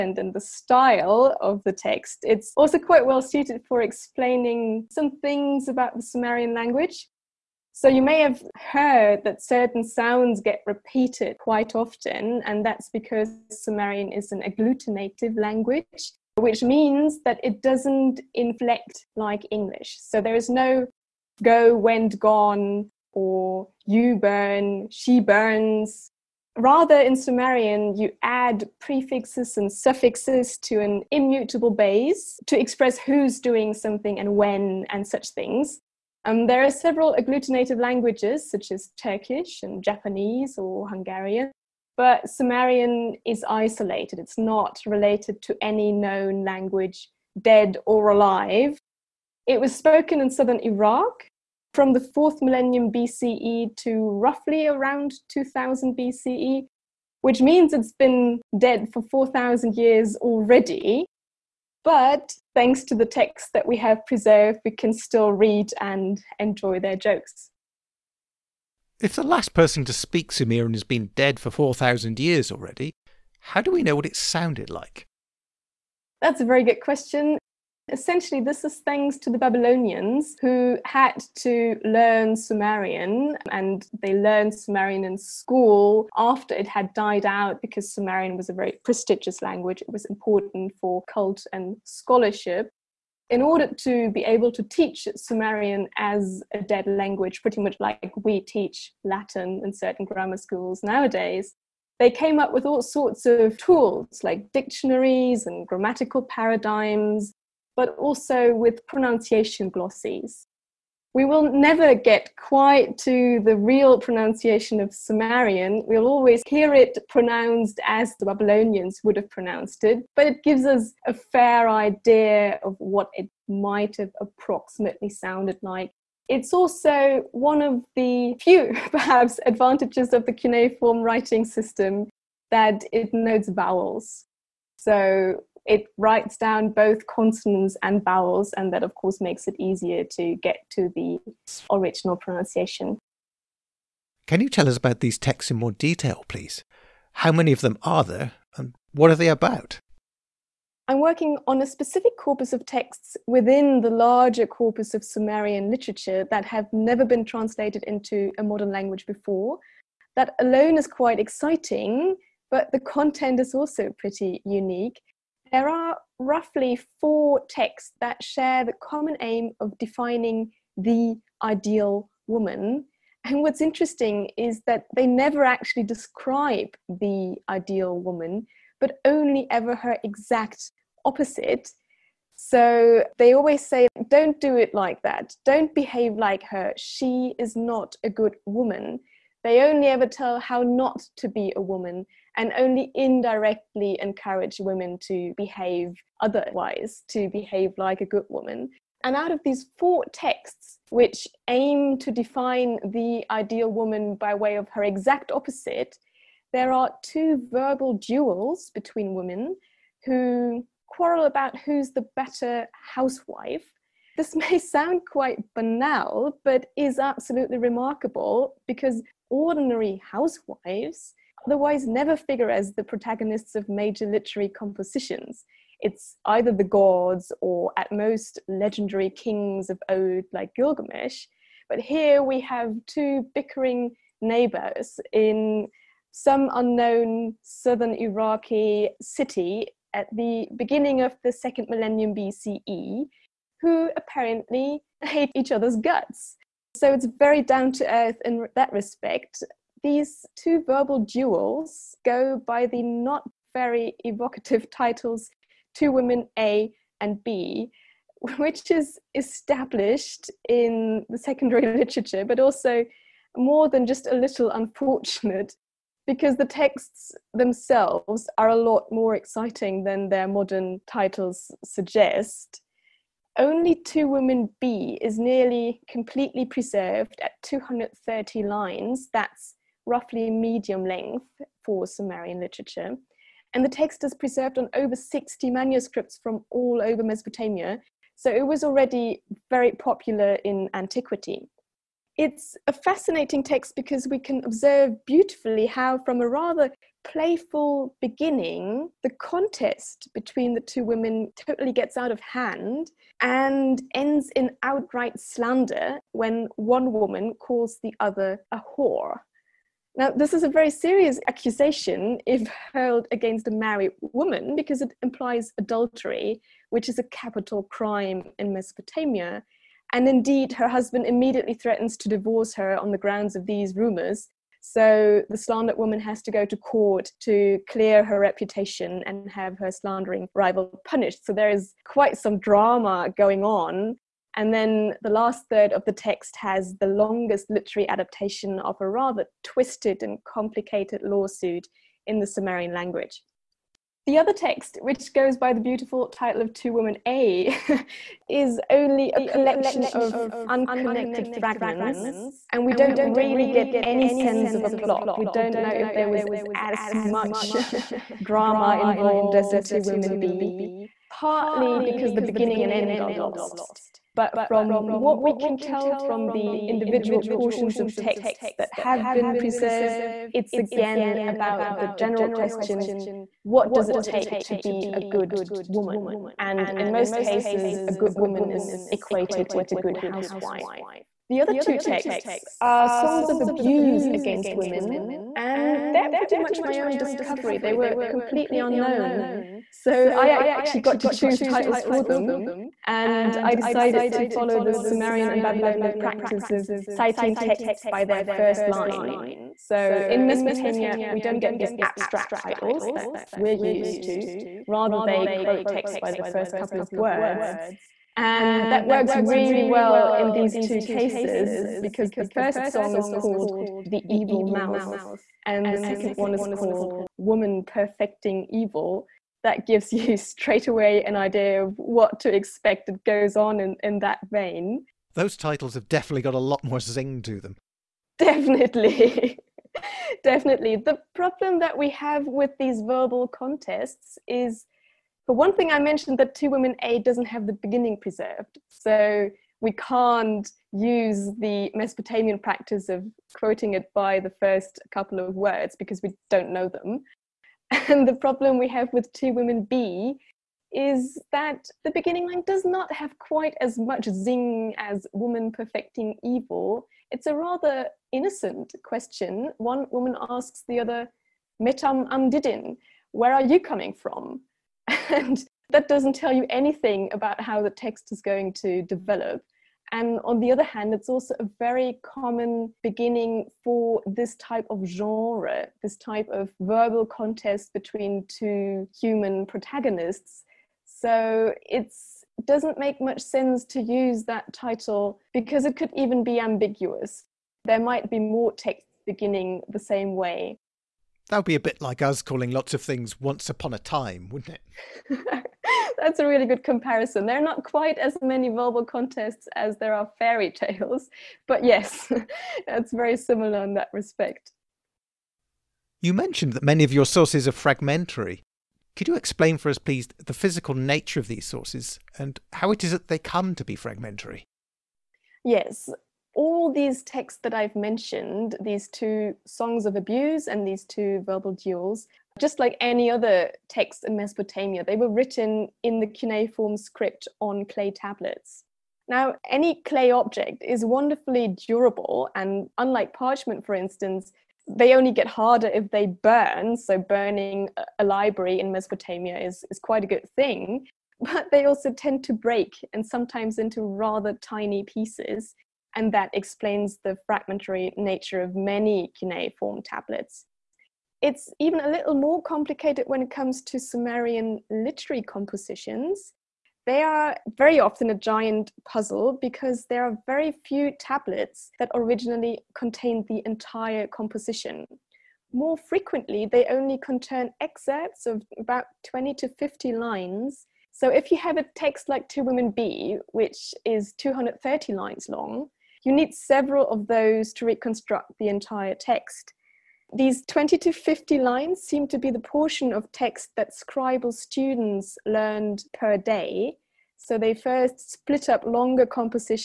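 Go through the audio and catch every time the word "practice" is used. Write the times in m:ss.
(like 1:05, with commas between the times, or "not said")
6:35, 7:22.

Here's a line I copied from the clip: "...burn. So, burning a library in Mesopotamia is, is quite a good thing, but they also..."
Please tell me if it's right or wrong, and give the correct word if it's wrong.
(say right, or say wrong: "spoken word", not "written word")
right.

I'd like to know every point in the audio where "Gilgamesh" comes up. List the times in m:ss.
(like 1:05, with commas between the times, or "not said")
3:50.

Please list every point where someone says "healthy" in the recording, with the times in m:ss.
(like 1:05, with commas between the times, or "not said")
not said.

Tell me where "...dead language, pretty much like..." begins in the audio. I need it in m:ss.
1:36.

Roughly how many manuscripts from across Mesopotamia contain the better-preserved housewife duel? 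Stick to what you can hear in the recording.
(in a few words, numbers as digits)
Over 60.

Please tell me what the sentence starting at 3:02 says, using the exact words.
So they always say, don't do it like that.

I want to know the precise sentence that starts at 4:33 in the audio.
Only Two Women B is nearly completely preserved at 230 lines.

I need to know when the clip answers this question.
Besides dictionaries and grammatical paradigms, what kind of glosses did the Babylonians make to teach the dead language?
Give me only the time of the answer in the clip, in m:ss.
1:48.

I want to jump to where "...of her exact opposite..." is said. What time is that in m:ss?
3:24.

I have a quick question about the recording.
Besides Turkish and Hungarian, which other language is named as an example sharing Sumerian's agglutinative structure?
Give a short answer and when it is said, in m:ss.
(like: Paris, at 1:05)
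Japanese, at 0:39.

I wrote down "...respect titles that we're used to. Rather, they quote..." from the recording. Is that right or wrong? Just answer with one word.
wrong.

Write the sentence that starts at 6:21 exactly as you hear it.
The other two texts are songs of abuse against women, and they're pretty much my own discovery.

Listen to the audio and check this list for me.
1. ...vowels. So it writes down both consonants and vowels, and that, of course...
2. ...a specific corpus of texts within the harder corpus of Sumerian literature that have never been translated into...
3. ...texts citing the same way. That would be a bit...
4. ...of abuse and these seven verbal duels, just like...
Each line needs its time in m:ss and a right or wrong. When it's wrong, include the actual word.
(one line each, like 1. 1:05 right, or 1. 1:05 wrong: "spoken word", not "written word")
1. 2:13 right
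2. 2:31 wrong: "larger", not "harder"
3. 8:08 wrong: "beginning", not "citing"
4. 8:39 wrong: "two", not "seven".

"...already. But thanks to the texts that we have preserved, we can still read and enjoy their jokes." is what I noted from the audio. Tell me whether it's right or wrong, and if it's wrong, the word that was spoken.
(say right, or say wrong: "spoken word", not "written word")
right.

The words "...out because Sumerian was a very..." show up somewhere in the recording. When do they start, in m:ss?
1:27.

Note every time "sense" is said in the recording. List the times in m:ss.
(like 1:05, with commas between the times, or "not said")
5:54, 8:03.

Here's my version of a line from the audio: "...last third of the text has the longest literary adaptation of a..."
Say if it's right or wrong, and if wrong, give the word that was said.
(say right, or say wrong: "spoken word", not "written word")
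right.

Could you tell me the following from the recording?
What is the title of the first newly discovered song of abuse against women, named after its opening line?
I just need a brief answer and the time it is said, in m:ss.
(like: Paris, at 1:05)
The Evil Mouth, at 6:53.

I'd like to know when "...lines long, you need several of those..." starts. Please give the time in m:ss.
9:34.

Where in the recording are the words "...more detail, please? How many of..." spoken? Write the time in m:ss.
2:25.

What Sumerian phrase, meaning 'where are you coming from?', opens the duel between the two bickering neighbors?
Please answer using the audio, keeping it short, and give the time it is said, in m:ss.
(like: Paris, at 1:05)
Metam Amdidin, at 7:41.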